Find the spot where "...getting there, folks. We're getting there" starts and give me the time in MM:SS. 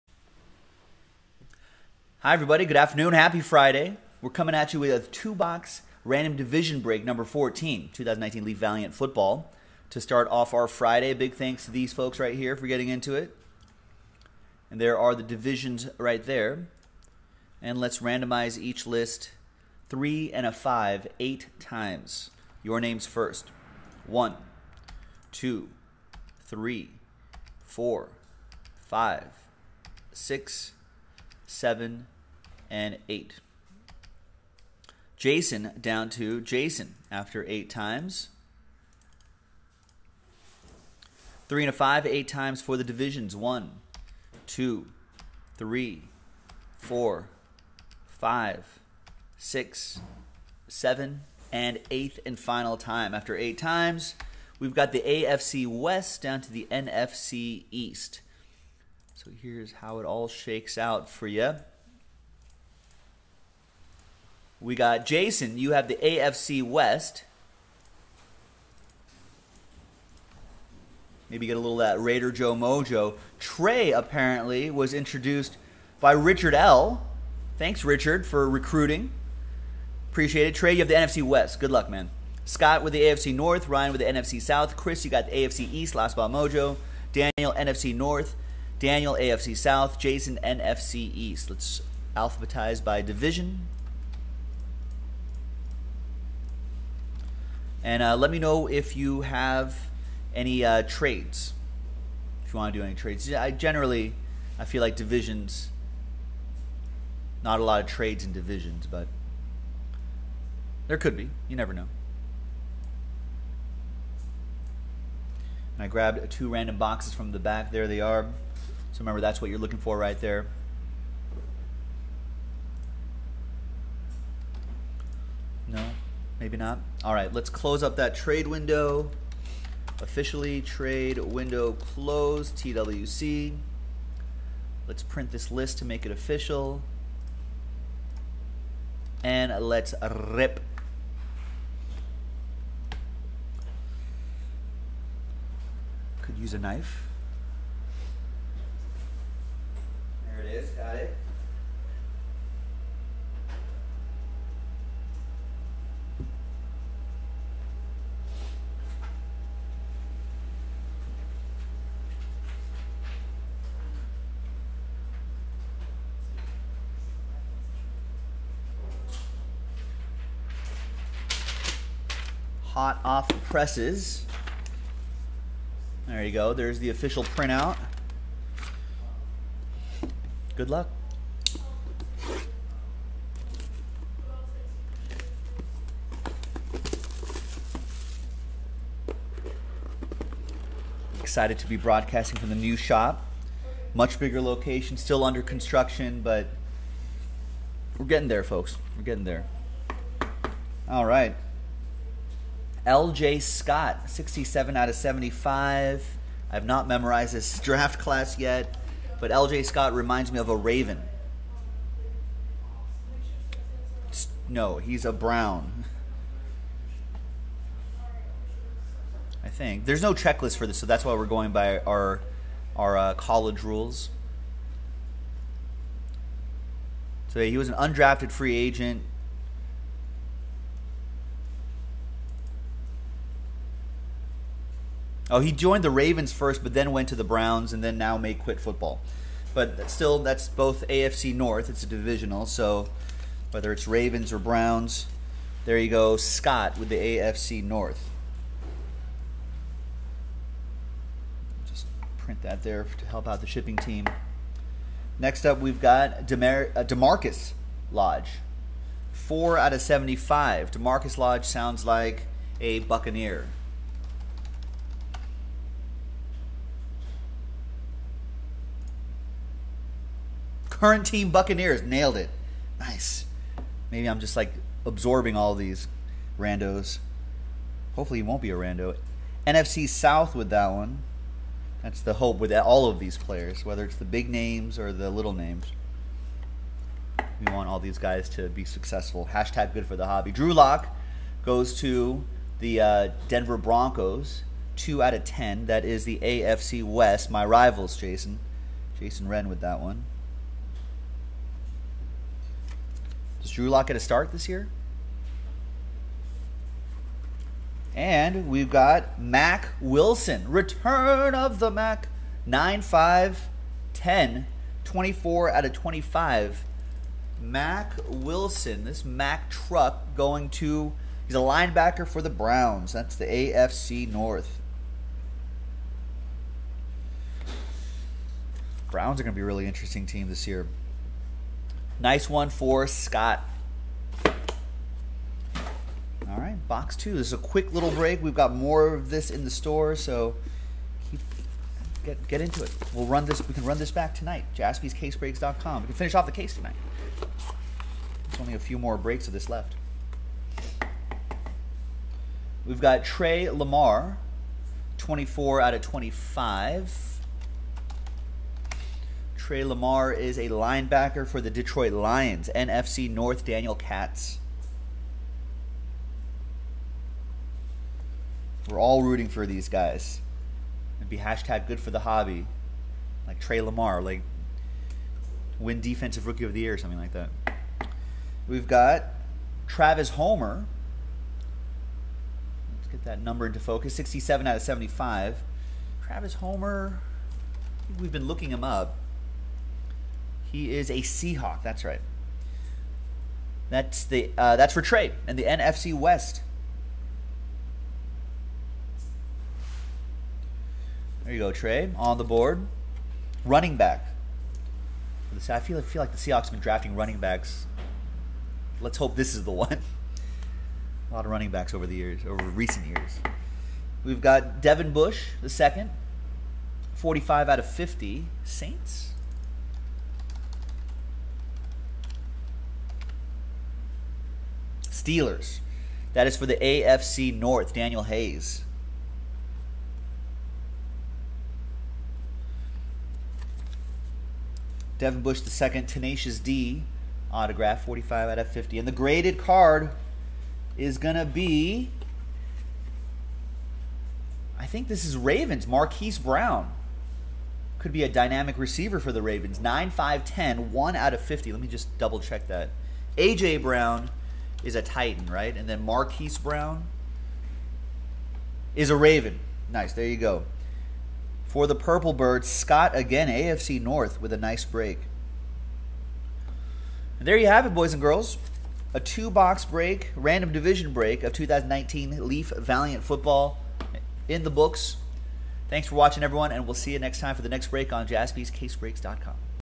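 03:18.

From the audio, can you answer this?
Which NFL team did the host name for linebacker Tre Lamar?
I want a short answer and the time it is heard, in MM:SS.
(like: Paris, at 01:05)
Detroit Lions, at 06:01.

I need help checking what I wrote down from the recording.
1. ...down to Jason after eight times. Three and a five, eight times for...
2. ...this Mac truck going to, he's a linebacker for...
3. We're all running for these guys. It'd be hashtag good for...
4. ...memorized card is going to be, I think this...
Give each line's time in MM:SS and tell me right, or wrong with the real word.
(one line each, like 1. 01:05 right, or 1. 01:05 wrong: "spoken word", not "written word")
1. 00:35 right
2. 05:18 right
3. 06:08 wrong: "rooting", not "running"
4. 07:18 wrong: "graded", not "memorized".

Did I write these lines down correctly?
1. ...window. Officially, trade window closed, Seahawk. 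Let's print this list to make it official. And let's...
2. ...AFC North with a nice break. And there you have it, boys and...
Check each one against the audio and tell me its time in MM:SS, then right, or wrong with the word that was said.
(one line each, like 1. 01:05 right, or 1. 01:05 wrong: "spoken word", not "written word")
1. 02:08 wrong: "TWC", not "Seahawk"
2. 07:43 right.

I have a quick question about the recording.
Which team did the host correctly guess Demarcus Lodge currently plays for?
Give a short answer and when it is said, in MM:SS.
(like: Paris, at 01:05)
Buccaneers, at 04:31.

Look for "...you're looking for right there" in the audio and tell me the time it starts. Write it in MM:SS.
01:59.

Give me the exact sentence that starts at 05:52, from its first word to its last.
We've got Tre Lamar, 24 out of 25.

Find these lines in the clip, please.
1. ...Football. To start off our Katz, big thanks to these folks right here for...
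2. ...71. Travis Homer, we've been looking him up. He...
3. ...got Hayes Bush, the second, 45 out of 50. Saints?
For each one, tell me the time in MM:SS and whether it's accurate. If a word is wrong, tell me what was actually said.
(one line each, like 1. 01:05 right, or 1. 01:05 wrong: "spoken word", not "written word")
1. 00:08 wrong: "Friday", not "Katz"
2. 06:24 wrong: "75", not "71"
3. 06:54 wrong: "Devin", not "Hayes".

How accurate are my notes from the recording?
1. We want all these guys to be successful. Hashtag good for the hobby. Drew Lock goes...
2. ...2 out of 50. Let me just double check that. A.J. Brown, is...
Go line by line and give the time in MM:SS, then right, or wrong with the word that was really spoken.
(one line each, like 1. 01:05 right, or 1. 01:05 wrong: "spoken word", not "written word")
1. 04:47 right
2. 07:30 wrong: "1", not "2".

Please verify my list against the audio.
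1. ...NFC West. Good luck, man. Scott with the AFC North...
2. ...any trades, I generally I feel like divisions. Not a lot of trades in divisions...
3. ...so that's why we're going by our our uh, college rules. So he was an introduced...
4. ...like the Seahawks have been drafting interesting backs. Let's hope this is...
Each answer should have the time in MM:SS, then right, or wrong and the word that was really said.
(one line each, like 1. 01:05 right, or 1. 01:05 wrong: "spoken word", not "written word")
1. 01:20 right
2. 01:42 right
3. 03:40 wrong: "undrafted", not "introduced"
4. 06:46 wrong: "running", not "interesting".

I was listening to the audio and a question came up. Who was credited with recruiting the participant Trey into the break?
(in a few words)
Richard L.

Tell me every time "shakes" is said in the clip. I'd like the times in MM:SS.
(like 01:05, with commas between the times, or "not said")
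01:00.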